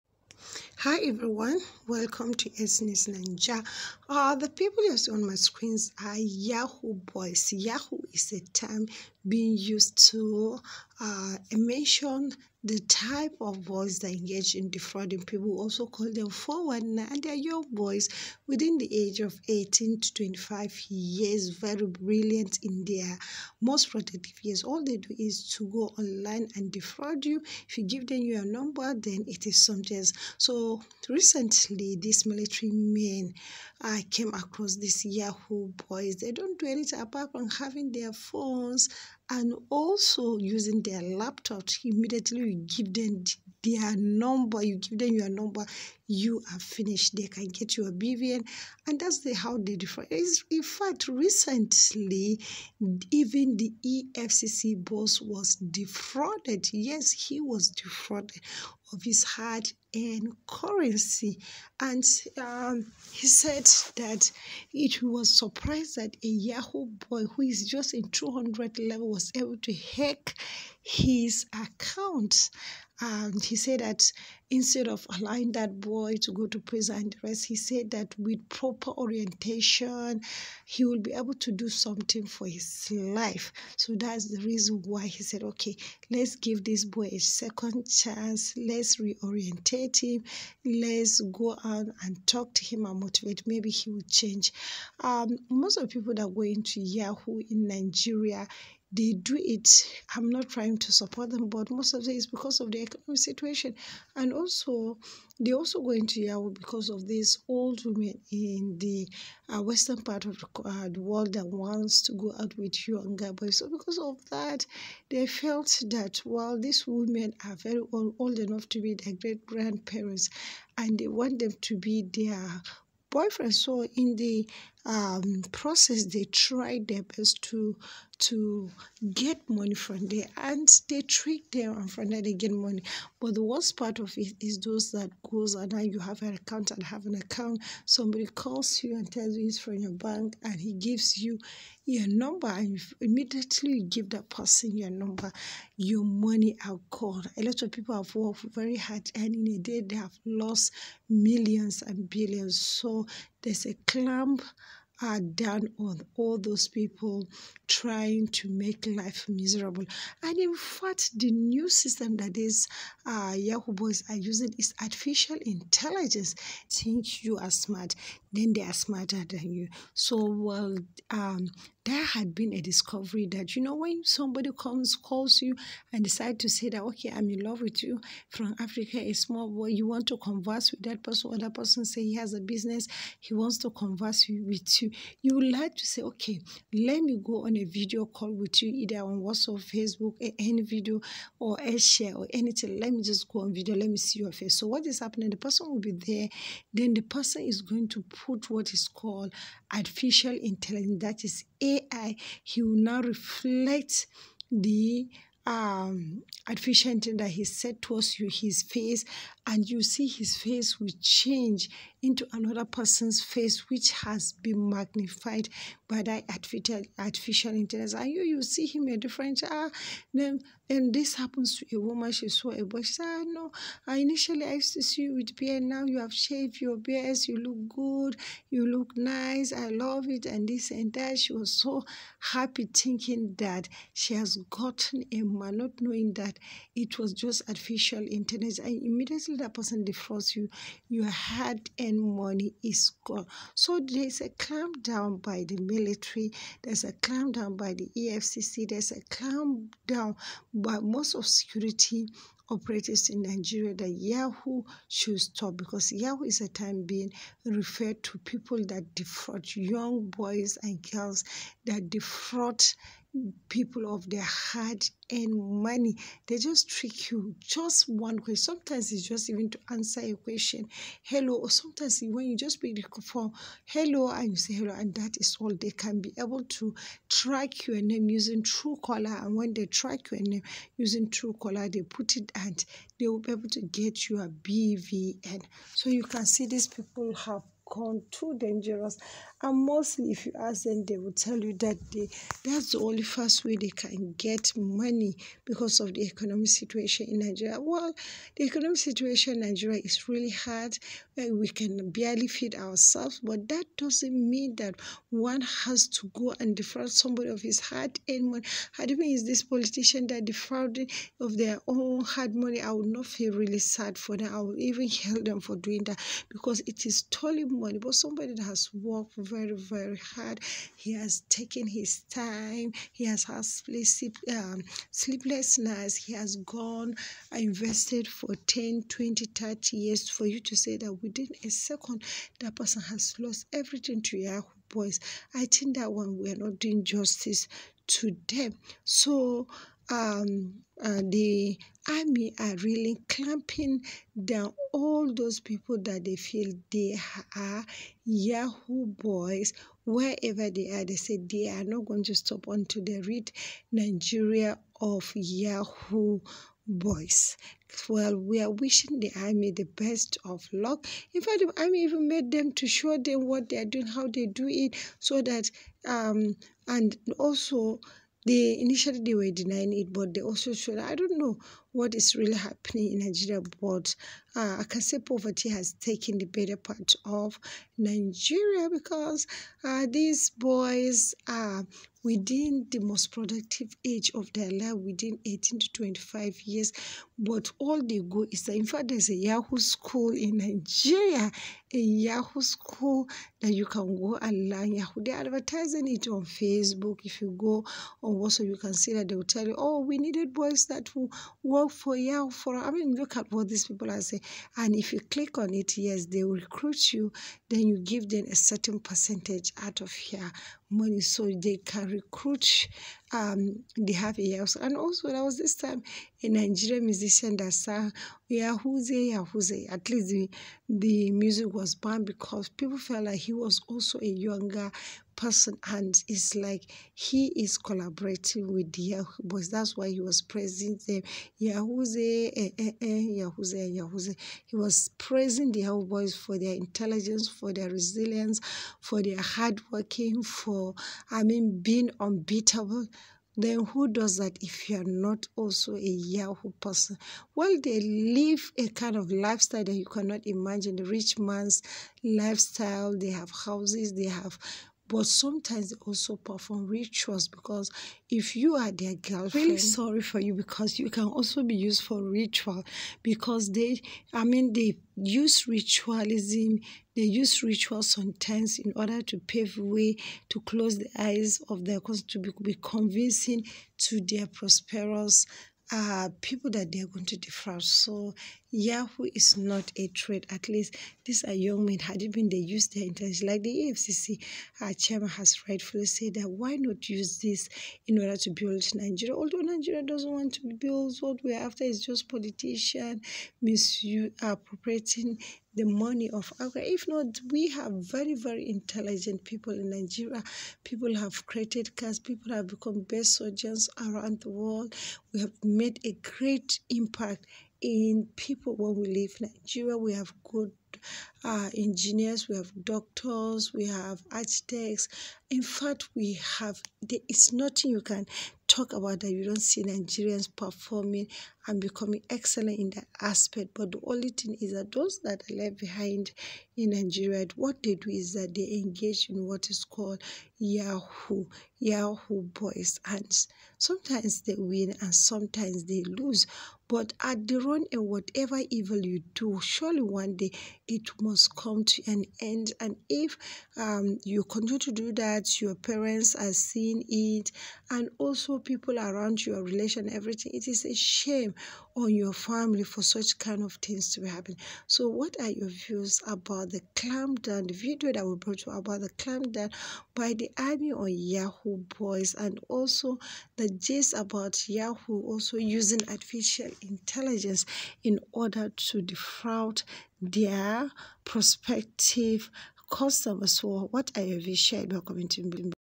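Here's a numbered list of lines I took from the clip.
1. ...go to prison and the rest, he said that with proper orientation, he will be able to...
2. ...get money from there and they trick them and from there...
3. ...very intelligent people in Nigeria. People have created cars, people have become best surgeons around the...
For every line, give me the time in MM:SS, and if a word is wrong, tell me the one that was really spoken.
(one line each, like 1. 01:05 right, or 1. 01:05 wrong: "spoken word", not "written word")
1. 01:16 right
2. 02:09 right
3. 08:18 right.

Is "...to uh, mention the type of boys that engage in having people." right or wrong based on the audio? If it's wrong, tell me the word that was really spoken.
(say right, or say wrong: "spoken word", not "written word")
wrong: "defrauding", not "having".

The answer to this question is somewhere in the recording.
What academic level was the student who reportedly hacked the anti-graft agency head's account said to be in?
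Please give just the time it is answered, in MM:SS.
01:08.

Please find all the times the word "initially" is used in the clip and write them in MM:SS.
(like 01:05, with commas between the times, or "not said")
03:43, 06:08.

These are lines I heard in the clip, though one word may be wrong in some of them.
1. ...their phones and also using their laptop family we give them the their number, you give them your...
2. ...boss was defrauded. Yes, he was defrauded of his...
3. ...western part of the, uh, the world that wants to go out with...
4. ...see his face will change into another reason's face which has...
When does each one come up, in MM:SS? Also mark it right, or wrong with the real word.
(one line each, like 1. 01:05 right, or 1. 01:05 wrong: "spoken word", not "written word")
1. 00:37 wrong: "immediately", not "family"
2. 00:54 right
3. 01:49 right
4. 03:29 wrong: "person", not "reason".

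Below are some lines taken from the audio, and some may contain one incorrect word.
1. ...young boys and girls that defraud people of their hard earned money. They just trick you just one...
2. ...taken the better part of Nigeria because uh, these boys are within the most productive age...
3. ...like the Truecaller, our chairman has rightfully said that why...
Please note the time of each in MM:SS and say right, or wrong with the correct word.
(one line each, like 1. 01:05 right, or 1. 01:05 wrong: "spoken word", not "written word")
1. 04:19 right
2. 06:15 right
3. 08:03 wrong: "AFCC", not "Truecaller".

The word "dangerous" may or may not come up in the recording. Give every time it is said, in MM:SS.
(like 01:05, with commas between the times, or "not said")
04:48.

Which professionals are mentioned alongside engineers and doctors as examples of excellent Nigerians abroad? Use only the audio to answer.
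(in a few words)
architects.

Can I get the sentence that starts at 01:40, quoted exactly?
I'm not trying to support them, but most of it is because of the economic situation.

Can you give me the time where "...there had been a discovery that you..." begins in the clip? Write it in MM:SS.
02:51.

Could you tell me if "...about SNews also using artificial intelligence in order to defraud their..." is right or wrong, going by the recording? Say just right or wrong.
wrong.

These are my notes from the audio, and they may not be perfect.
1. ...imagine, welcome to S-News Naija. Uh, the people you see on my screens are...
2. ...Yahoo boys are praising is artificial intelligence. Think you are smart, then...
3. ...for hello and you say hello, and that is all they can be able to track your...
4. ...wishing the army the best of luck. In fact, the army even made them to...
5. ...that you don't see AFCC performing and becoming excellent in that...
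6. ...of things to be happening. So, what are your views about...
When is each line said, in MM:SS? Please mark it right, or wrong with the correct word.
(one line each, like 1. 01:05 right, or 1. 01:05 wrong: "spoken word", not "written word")
1. 00:01 wrong: "everyone", not "imagine"
2. 02:43 wrong: "using", not "praising"
3. 04:33 right
4. 05:58 right
5. 08:39 wrong: "Nigerians", not "AFCC"
6. 09:13 right.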